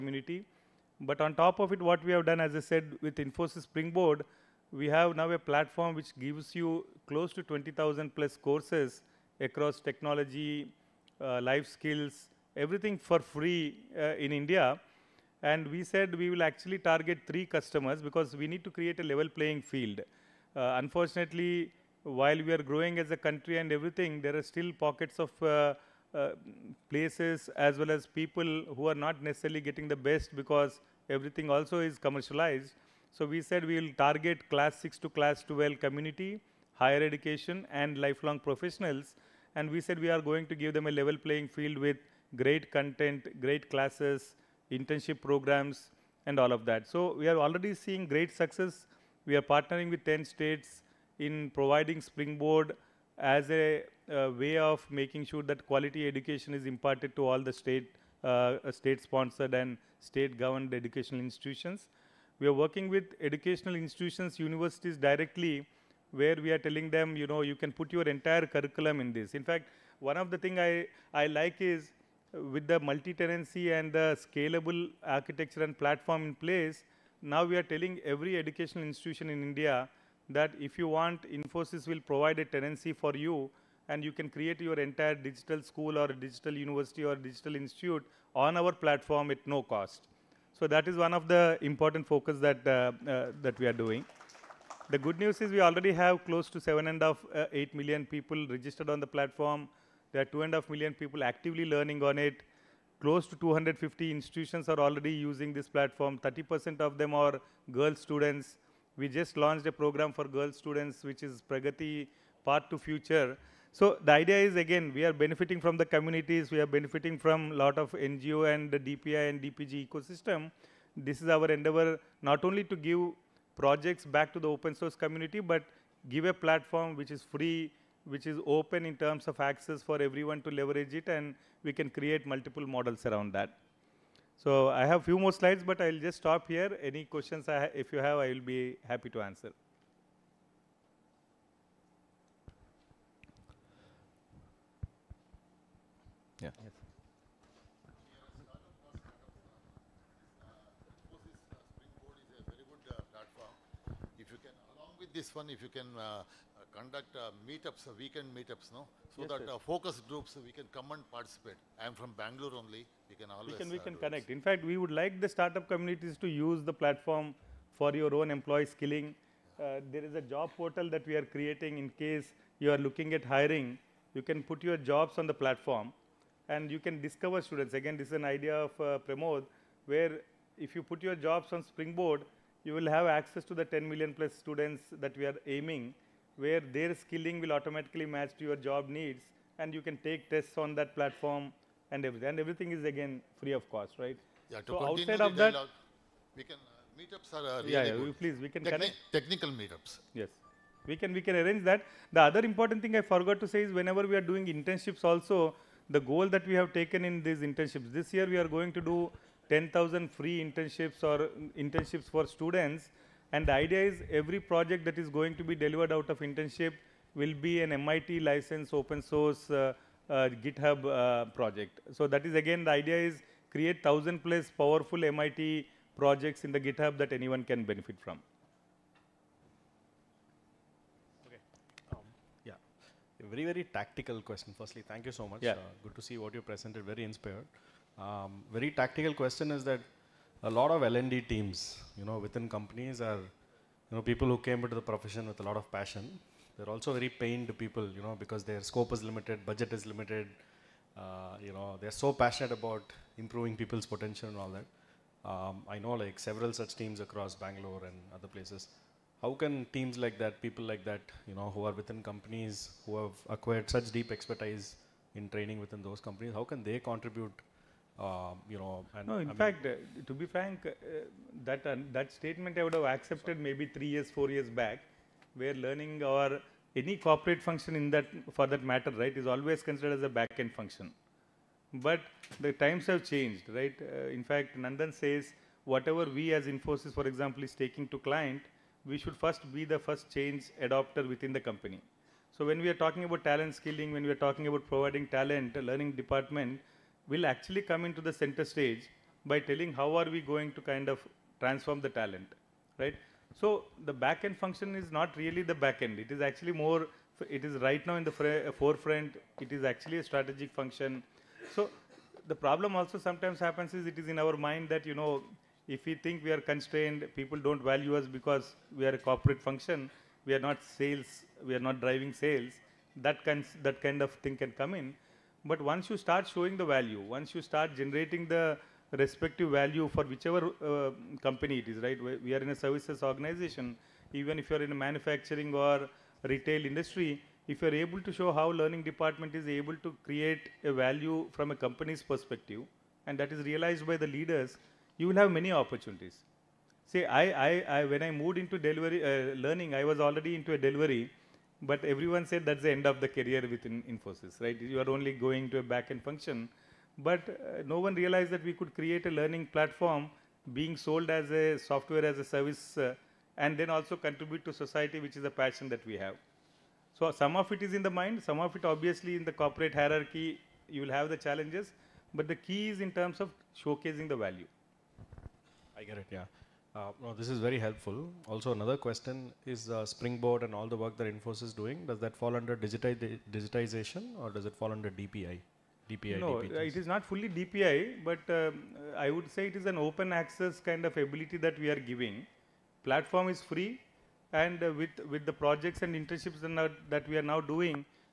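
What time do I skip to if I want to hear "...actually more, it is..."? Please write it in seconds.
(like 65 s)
306 s.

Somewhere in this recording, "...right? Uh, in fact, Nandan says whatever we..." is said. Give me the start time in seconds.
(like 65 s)
283 s.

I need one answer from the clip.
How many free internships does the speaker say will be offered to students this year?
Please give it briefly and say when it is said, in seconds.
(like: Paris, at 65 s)
10,000, at 209 s.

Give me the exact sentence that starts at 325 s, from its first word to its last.
But once you start showing the value, once you start generating the respective value for whichever uh, company it is, right?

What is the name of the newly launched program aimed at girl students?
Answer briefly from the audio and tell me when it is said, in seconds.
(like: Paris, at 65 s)
Pragati Path to Future, at 111 s.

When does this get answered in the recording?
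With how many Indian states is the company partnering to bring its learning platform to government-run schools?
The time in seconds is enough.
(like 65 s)
50 s.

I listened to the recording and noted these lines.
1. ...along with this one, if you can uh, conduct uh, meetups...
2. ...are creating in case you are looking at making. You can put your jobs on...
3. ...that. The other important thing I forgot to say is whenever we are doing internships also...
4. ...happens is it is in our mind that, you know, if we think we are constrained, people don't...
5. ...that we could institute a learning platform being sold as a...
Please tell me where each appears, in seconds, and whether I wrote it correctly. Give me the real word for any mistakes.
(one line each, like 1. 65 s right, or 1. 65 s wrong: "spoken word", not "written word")
1. 154 s right
2. 171 s wrong: "hiring", not "making"
3. 201 s right
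4. 313 s right
5. 358 s wrong: "create", not "institute".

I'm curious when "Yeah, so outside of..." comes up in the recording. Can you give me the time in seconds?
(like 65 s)
194 s.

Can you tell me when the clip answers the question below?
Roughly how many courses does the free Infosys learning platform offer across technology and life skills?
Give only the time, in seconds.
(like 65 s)
7 s.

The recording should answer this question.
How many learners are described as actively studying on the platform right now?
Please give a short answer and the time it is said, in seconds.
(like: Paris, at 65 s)
2.5 million, at 100 s.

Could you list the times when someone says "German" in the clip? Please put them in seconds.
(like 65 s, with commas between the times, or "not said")
not said.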